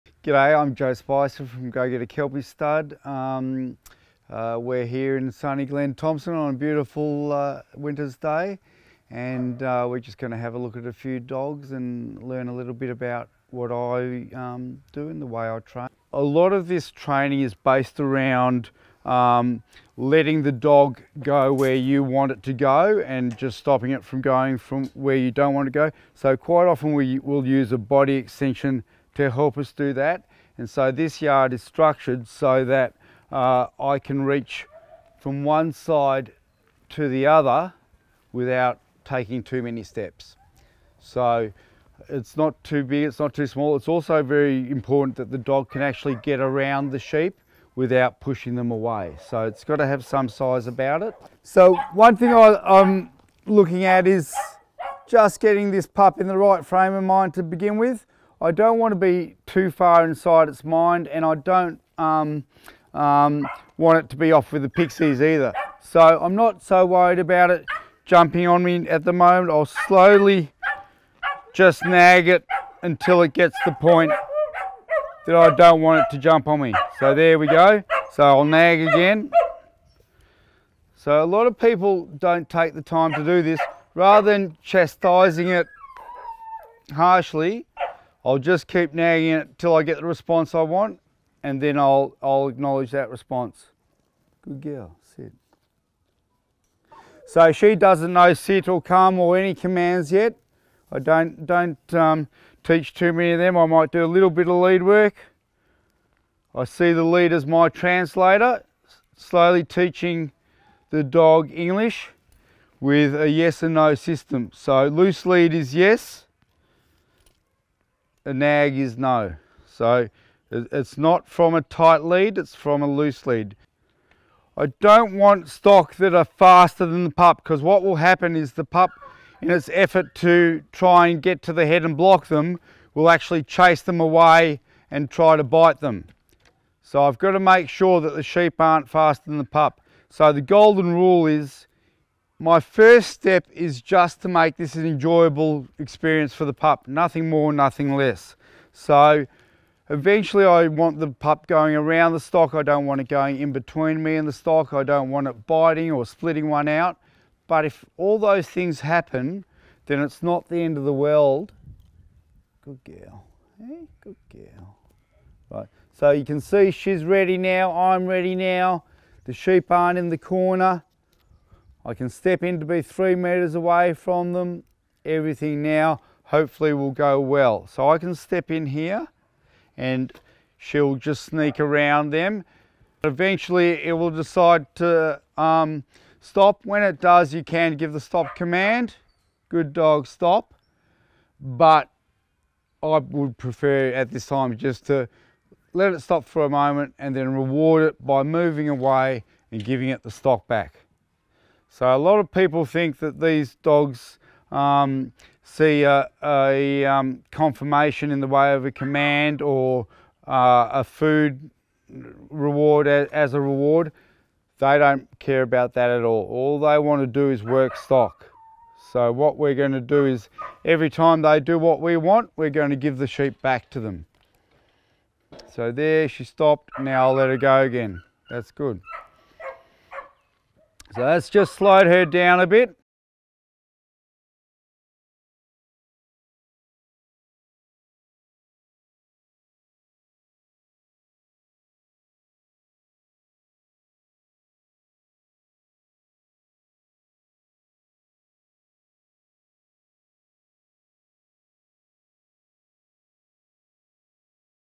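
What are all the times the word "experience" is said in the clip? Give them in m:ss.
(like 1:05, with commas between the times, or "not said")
2:25.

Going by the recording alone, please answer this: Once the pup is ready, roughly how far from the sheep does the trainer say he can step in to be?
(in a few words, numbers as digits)
3 meters.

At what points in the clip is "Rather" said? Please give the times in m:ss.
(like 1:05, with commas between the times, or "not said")
1:23.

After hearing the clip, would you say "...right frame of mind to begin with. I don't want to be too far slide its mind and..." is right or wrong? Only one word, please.
wrong.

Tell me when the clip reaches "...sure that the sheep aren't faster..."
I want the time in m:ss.
2:17.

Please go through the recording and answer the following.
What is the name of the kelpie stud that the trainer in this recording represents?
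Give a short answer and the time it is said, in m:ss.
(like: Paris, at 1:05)
GoGetta Kelpie Stud, at 0:01.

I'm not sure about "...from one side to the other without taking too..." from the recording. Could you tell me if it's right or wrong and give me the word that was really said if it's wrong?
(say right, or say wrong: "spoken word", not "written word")
right.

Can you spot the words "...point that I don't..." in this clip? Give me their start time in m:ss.
1:13.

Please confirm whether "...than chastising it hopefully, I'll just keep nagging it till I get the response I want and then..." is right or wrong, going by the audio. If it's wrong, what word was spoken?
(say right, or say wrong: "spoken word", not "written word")
wrong: "harshly", not "hopefully".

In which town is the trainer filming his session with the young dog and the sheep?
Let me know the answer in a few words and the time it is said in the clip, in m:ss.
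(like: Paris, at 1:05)
Glen Thompson, at 0:05.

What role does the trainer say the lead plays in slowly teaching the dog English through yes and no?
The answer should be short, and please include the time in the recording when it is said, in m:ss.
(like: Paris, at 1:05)
translator, at 1:47.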